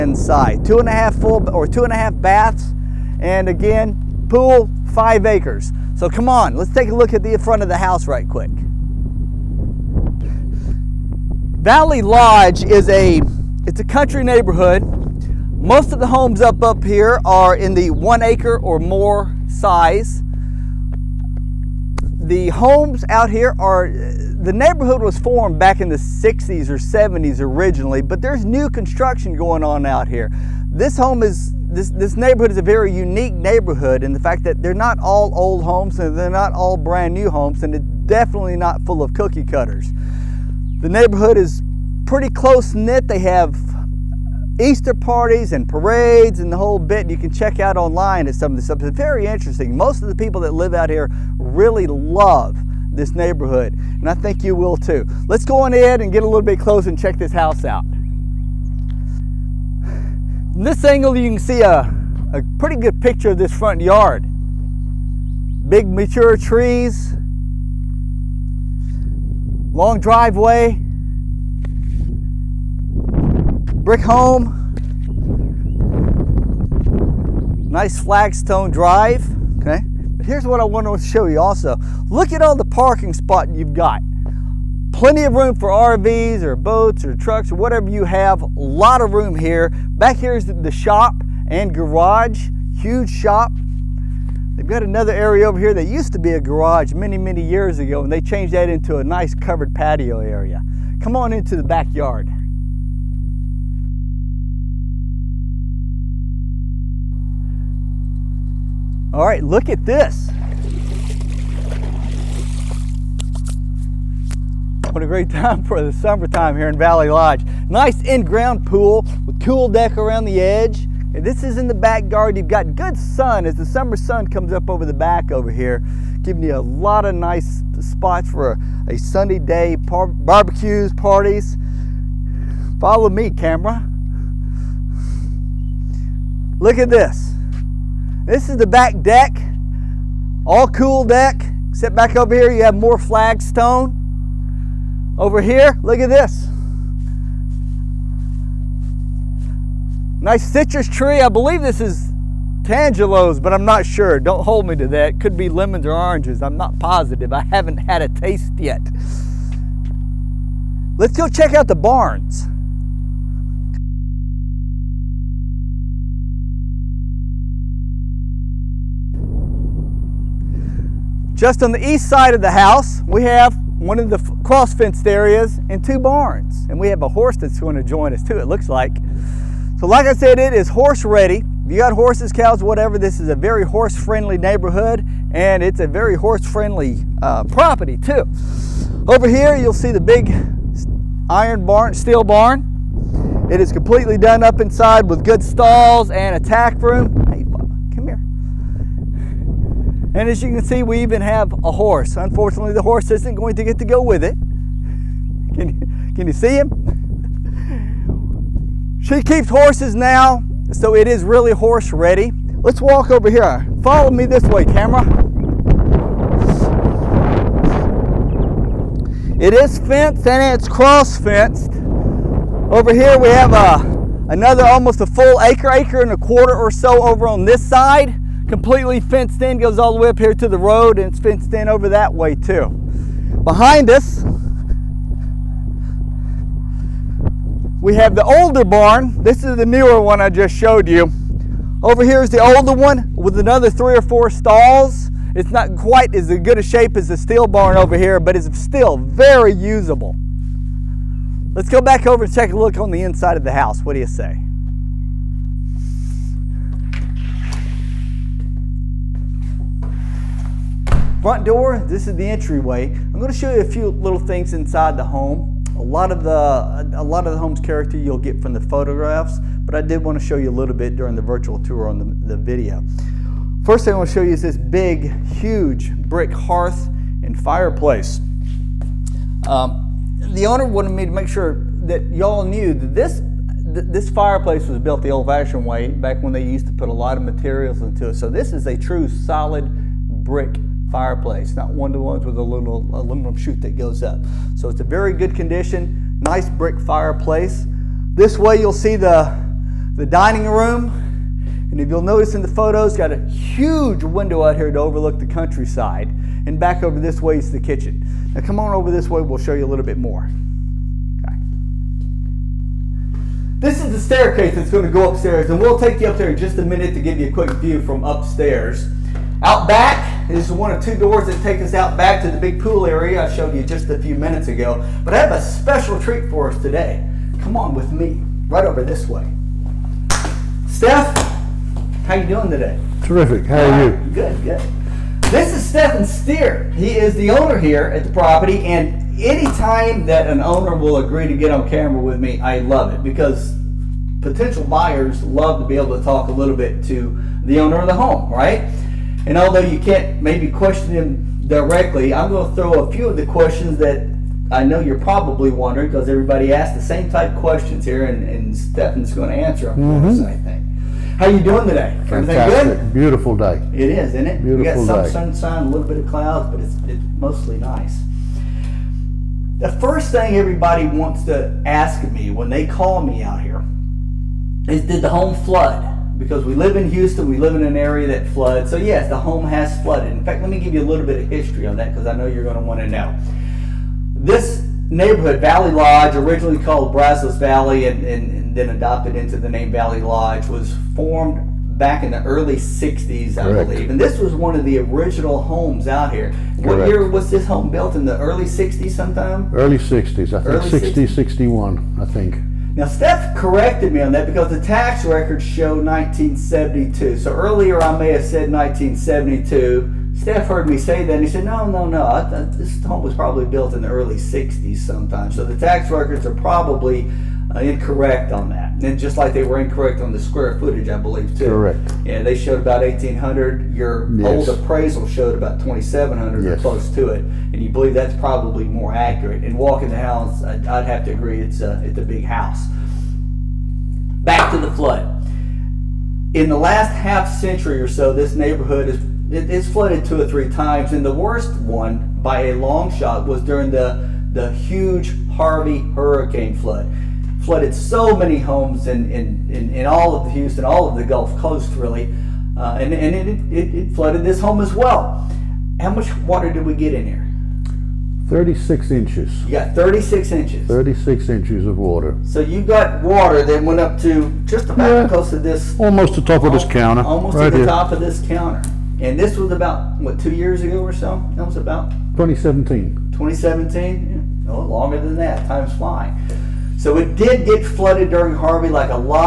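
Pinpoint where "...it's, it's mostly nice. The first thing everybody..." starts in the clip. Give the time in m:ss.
6:06.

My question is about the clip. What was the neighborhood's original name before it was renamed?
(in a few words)
Brazos Valley.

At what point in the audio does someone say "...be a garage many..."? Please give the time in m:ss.
1:36.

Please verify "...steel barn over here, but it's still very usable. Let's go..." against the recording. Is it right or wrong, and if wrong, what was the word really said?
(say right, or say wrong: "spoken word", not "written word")
right.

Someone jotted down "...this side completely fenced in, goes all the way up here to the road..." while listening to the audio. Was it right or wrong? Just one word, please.
right.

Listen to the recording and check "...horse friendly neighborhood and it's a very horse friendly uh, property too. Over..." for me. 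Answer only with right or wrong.
right.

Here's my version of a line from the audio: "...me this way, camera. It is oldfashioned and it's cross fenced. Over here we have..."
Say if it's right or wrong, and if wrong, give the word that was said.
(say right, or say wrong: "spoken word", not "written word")
wrong: "fenced", not "oldfashioned".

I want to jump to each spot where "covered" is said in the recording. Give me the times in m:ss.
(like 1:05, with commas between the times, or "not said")
1:39.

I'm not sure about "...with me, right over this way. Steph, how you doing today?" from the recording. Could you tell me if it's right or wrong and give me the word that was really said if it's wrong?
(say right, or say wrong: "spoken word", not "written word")
right.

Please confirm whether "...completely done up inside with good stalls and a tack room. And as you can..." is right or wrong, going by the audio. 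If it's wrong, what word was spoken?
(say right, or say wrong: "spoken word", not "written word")
right.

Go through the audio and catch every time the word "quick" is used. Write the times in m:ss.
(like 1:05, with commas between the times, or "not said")
0:08, 5:17.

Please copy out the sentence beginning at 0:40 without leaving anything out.
The neighborhood is pretty close knit.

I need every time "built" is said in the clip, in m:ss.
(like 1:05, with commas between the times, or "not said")
4:44, 6:37, 6:53.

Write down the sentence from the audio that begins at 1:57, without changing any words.
Nice in-ground pool with cool deck around the edge.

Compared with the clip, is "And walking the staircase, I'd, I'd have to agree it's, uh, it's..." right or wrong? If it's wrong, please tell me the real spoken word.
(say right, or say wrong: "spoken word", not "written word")
wrong: "house", not "staircase".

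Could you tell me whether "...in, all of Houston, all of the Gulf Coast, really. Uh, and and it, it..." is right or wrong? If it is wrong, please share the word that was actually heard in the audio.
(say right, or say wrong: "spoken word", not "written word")
right.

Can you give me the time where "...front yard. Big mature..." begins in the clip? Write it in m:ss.
1:03.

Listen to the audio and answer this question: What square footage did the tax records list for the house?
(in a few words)
1,800.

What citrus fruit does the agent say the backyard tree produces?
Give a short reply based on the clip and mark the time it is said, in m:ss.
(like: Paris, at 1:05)
Tangelos, at 2:32.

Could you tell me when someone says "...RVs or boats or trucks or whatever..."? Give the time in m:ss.
1:25.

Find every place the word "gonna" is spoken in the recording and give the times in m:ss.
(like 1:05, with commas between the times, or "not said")
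4:23, 5:14.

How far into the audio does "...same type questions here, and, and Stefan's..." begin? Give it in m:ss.
5:56.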